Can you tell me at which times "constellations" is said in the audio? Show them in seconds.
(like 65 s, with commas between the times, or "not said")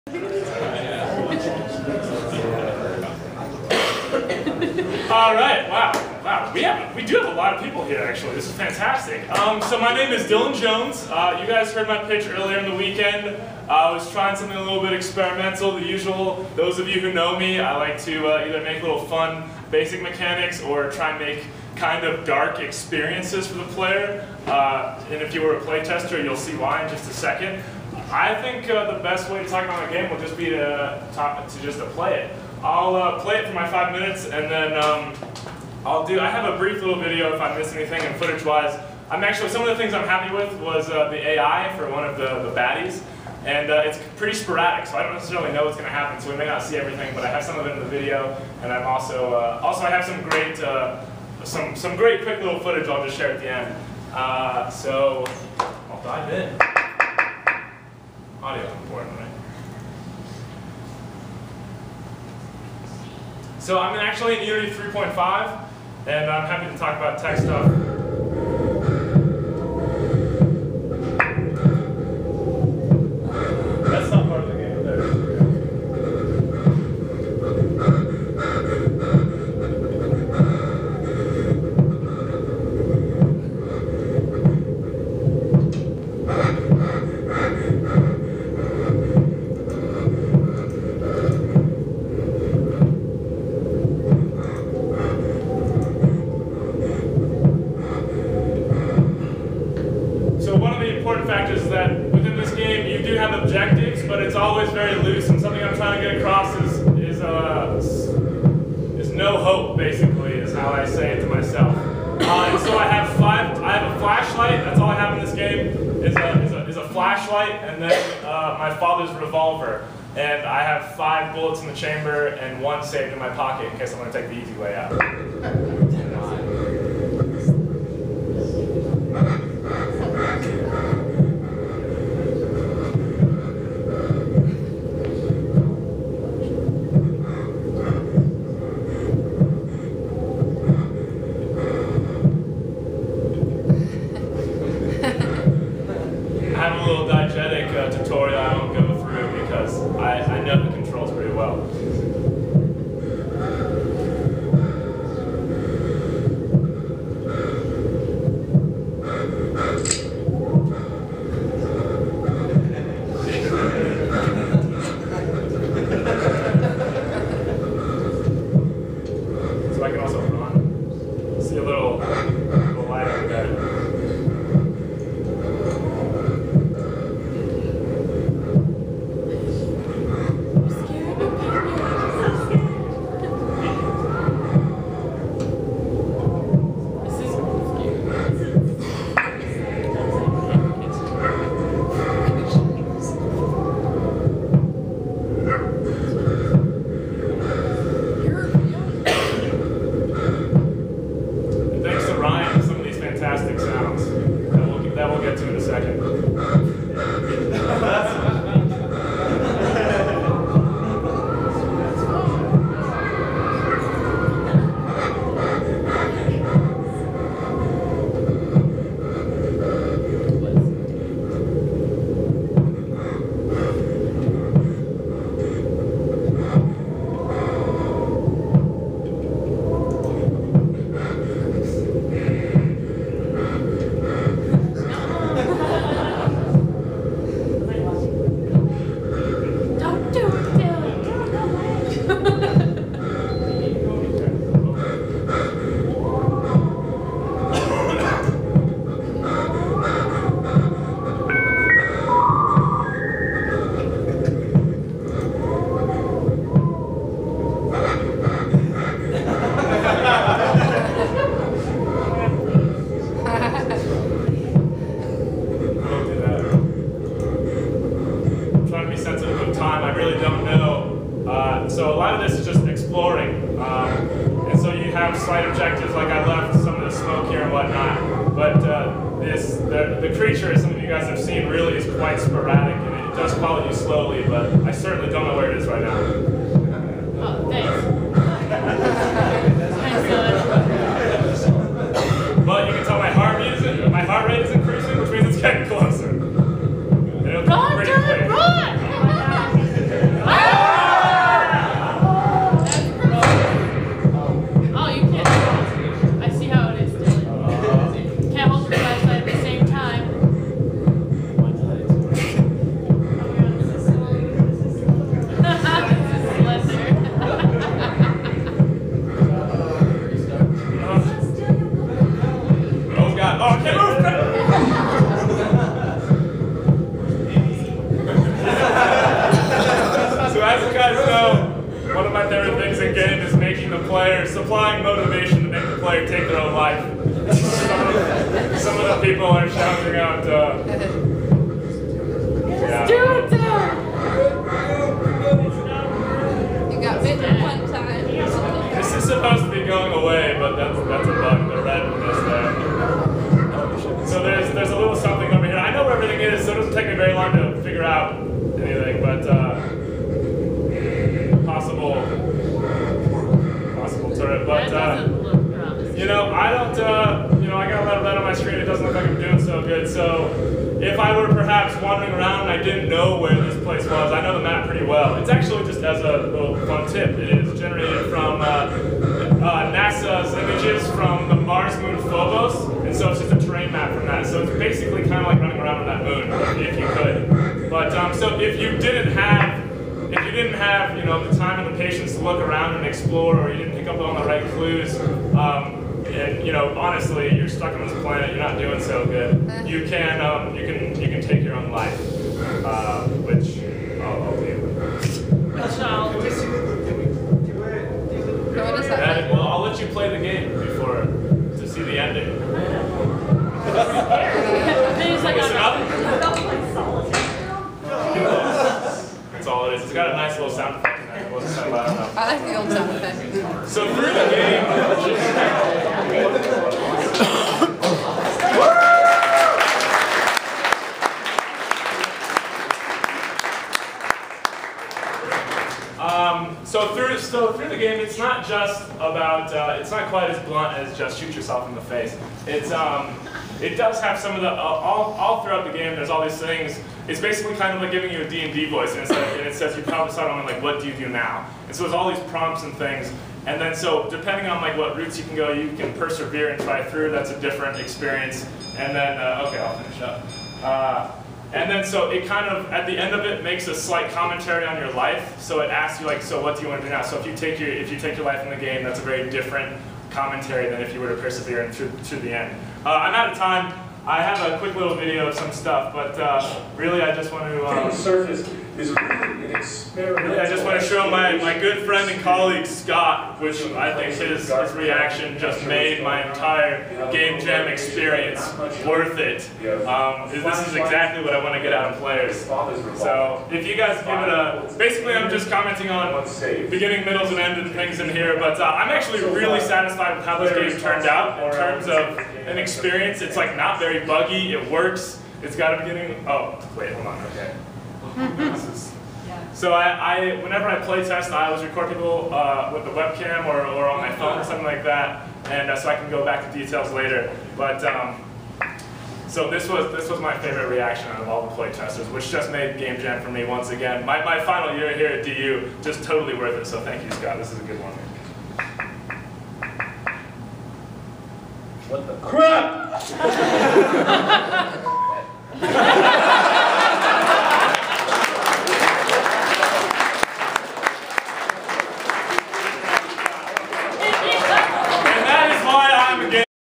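not said.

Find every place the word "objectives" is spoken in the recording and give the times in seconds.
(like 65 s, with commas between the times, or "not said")
103 s, 275 s.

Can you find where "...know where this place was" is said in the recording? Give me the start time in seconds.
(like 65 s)
372 s.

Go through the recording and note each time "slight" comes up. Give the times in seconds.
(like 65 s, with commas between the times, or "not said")
275 s, 463 s.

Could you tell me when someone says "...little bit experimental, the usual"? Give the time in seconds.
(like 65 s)
14 s.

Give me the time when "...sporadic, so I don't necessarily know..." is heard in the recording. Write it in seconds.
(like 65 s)
44 s.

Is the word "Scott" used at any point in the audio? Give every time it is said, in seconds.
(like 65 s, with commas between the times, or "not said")
482 s, 527 s.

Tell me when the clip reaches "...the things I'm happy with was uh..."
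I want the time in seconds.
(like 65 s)
39 s.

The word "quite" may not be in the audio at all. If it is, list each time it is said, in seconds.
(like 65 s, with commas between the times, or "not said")
281 s, 440 s.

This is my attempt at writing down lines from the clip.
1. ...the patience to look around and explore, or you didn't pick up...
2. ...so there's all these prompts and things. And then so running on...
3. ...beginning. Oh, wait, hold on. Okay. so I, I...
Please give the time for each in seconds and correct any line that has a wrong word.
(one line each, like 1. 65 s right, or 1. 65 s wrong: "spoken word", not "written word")
1. 391 s right
2. 451 s wrong: "depending", not "running"
3. 505 s right.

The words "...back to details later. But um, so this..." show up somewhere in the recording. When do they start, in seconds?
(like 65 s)
516 s.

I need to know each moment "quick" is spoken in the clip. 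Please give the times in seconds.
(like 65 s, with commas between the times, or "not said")
52 s, 474 s.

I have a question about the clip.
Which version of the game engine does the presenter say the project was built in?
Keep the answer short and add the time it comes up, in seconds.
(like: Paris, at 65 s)
Unity 3.5, at 64 s.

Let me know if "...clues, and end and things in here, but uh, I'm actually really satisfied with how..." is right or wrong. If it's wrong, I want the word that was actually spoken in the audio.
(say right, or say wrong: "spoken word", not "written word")
wrong: "middles", not "clues".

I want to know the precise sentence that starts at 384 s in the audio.
So it's basically kind of like running around on that moon, if you could.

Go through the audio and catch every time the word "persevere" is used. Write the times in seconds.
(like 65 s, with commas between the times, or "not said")
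455 s, 471 s.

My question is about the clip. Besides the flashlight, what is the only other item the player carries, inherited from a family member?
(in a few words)
father's revolver.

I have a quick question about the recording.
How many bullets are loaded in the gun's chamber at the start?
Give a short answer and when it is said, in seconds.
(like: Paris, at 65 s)
5, at 120 s.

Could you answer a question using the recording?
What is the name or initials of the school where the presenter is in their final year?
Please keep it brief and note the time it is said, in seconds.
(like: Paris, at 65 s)
DU, at 525 s.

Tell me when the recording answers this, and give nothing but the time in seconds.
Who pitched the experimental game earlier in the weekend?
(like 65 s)
10 s.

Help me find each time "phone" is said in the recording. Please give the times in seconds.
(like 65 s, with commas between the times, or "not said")
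514 s.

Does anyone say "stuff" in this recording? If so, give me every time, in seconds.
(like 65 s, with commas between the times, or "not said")
67 s, 475 s.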